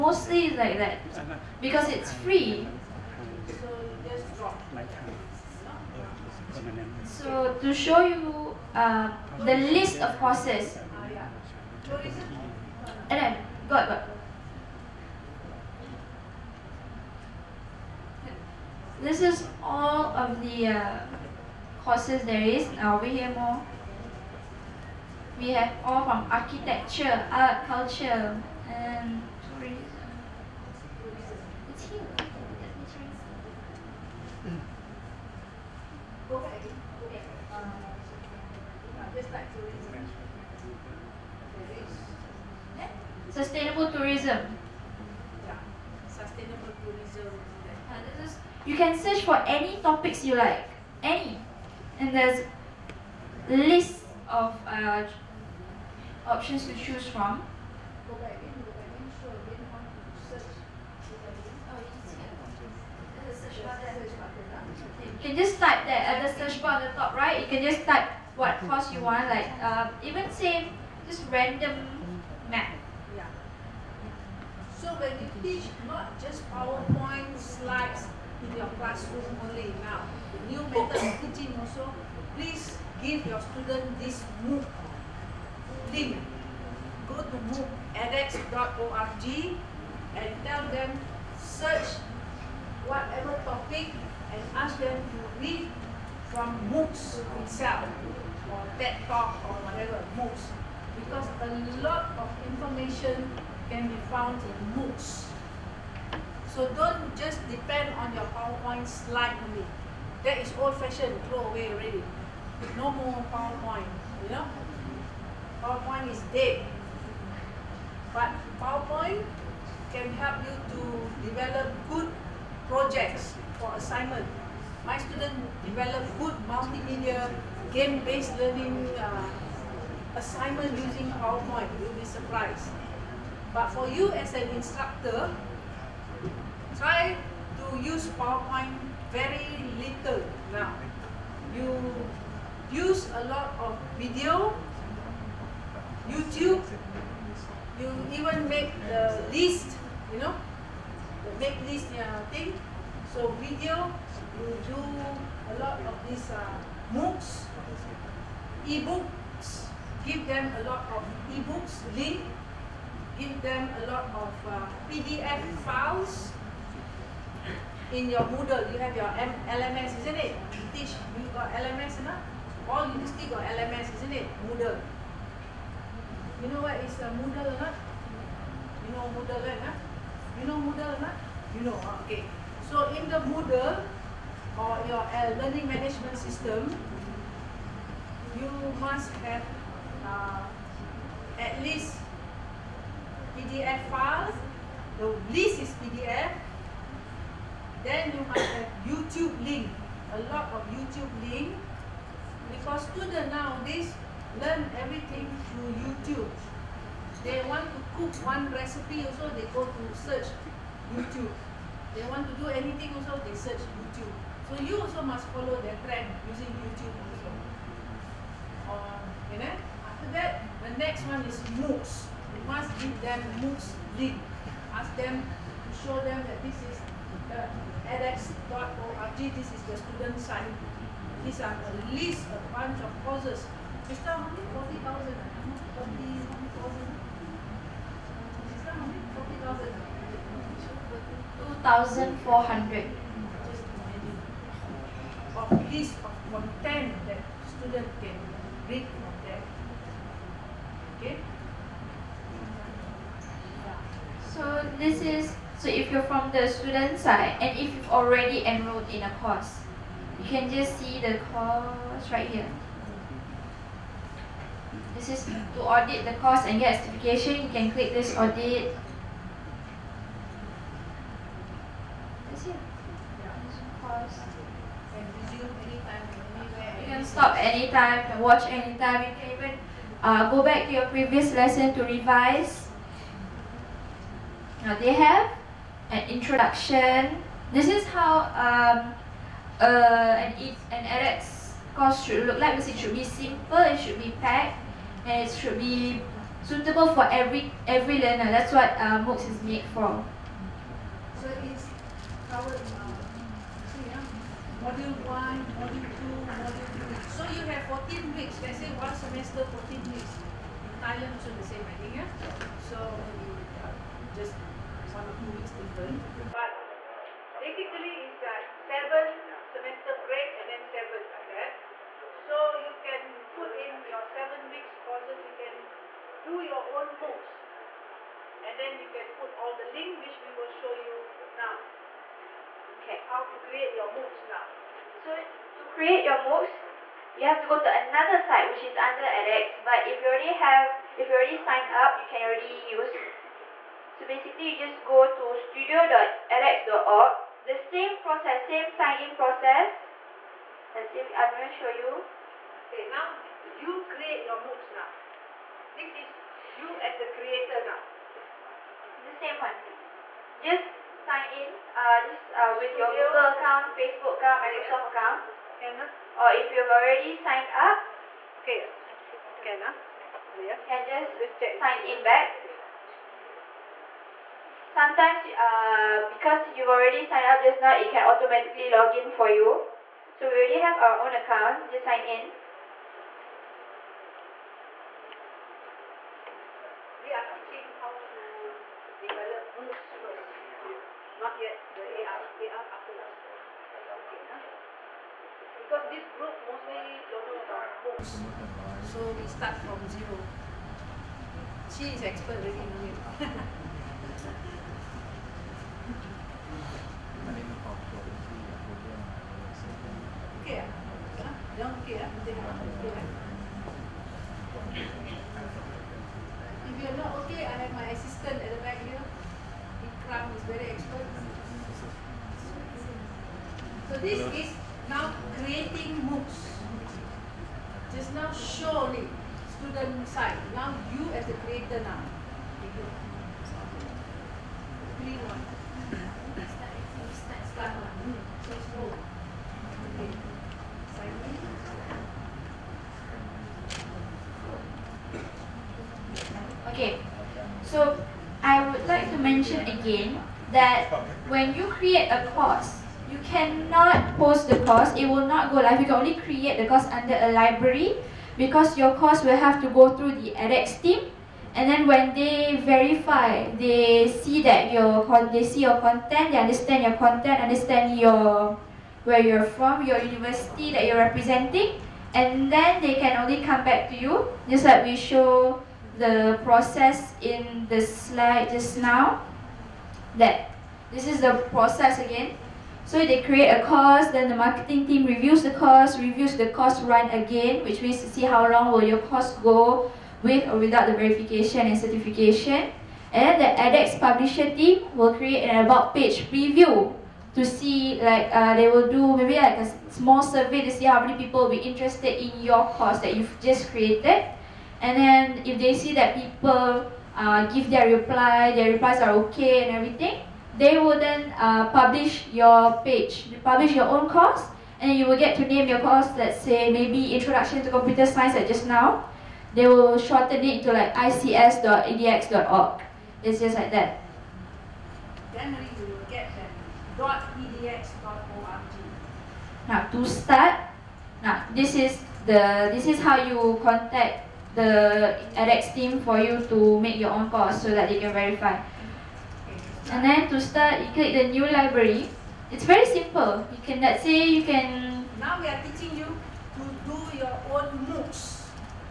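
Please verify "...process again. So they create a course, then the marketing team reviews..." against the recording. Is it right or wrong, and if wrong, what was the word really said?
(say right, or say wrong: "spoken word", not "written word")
right.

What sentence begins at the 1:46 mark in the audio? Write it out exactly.
So don't just depend on your PowerPoint slide only.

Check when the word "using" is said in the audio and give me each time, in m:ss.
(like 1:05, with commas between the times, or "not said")
2:10, 3:36.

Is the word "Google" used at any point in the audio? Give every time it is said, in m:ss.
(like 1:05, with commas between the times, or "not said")
6:03.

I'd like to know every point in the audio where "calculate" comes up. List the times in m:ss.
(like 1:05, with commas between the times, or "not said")
not said.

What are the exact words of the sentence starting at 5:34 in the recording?
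So to create your MOOCs, you have to go to another site which is under edX.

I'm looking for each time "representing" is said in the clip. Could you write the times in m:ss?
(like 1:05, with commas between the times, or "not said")
7:51.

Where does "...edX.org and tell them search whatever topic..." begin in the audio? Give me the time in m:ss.
1:27.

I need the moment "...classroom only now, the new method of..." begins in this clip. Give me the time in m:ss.
1:18.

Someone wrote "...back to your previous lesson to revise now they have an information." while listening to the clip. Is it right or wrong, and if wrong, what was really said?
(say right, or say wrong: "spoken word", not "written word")
wrong: "introduction", not "information".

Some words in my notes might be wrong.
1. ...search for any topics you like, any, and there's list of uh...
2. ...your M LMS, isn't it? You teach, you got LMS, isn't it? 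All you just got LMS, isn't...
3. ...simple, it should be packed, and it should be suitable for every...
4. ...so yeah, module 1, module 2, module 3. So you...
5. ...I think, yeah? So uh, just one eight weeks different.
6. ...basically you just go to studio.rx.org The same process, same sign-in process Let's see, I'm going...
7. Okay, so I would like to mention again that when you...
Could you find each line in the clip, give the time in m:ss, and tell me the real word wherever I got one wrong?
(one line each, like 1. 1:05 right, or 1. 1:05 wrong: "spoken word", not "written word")
1. 0:48 right
2. 2:48 right
3. 4:53 right
4. 5:03 right
5. 5:11 wrong: "two", not "eight"
6. 5:44 right
7. 7:26 right.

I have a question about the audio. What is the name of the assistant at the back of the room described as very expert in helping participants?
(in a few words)
Ikram.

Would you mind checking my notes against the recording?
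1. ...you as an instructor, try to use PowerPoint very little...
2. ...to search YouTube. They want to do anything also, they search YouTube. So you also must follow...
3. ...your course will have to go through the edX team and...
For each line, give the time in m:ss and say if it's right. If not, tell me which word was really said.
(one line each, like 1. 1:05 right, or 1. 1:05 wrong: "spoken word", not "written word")
1. 2:13 right
2. 3:29 right
3. 7:38 right.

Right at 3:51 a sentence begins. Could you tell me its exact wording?
These are a list, a bunch of courses.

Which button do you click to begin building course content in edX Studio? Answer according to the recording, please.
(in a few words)
New library.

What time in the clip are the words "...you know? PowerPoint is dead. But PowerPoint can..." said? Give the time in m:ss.
1:54.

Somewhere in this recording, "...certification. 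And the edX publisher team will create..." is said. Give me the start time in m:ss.
8:11.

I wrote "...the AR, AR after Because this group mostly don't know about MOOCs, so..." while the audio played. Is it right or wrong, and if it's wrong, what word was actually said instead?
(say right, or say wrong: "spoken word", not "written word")
right.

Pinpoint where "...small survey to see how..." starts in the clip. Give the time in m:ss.
8:19.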